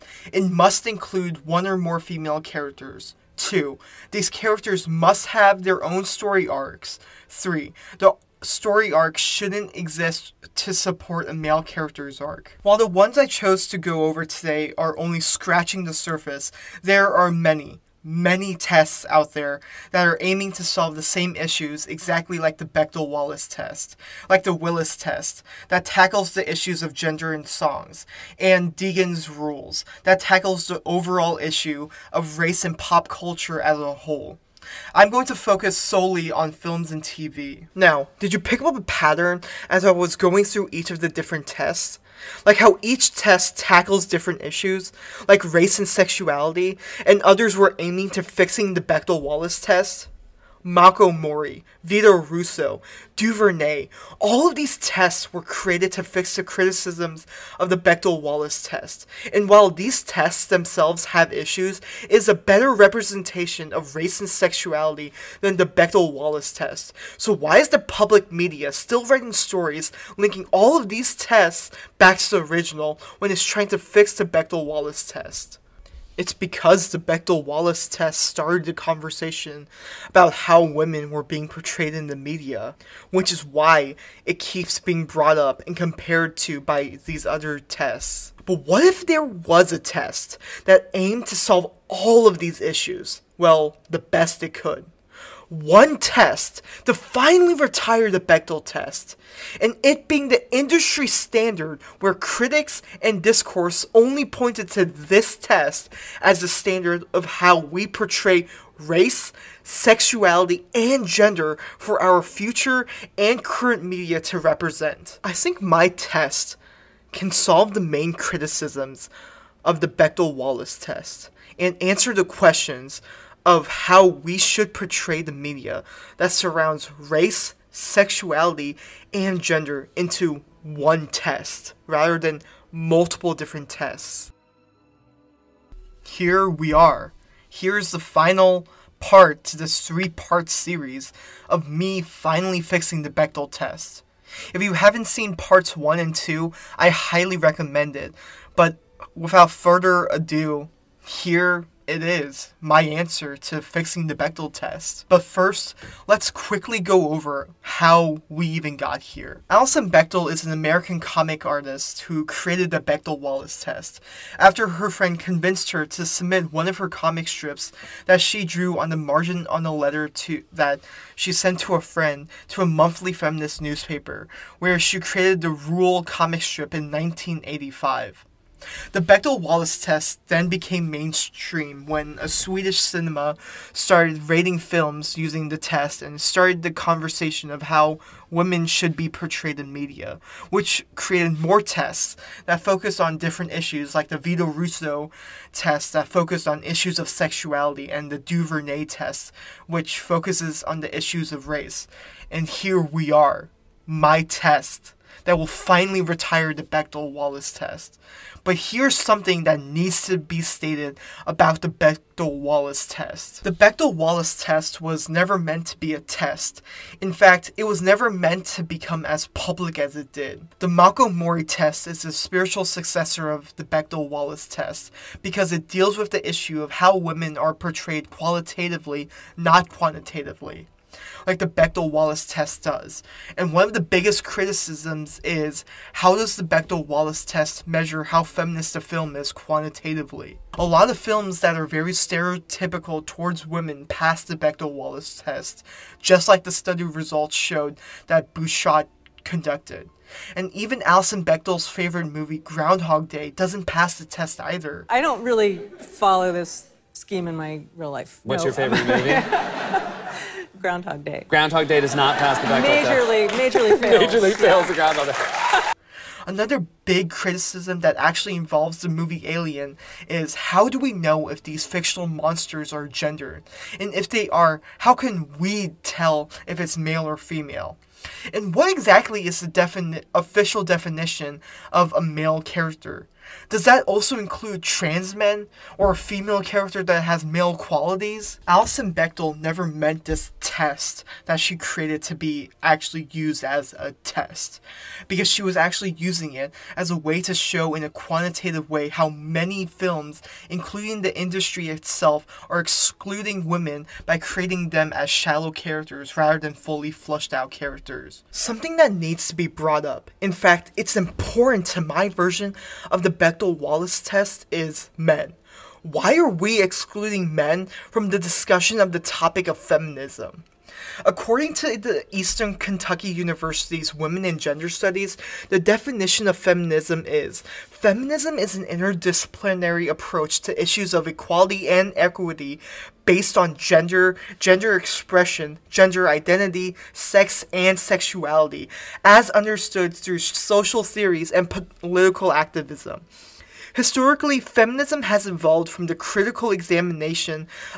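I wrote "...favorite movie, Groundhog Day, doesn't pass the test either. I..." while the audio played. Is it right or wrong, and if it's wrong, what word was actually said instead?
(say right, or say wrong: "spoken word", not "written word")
right.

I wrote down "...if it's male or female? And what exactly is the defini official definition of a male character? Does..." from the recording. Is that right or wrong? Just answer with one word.
right.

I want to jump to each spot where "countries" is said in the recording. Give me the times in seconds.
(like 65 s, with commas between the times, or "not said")
not said.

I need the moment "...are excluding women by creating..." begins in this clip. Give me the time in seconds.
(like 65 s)
302 s.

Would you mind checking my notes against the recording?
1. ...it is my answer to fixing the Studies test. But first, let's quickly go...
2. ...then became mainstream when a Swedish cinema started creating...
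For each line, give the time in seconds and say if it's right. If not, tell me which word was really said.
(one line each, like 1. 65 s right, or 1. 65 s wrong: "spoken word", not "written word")
1. 151 s wrong: "Bechdel", not "Studies"
2. 180 s wrong: "rating", not "creating".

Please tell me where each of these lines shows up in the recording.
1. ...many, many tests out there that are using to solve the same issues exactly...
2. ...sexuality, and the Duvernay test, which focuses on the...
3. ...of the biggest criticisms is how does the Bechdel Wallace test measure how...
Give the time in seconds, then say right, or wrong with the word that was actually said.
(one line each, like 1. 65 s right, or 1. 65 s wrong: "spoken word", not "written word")
1. 17 s wrong: "aiming", not "using"
2. 197 s right
3. 233 s right.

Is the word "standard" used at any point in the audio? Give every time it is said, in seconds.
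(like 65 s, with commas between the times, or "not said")
101 s, 106 s.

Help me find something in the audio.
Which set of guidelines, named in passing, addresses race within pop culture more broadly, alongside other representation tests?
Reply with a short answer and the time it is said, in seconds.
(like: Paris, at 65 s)
Deegan's Rules, at 28 s.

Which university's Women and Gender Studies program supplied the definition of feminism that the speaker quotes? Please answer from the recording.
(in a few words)
Eastern Kentucky University.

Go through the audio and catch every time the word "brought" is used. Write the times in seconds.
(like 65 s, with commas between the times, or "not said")
85 s, 309 s.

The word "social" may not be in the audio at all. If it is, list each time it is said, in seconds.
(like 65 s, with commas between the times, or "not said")
340 s.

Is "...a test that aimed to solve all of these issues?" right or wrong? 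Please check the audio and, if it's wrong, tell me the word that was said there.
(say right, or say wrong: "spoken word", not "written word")
right.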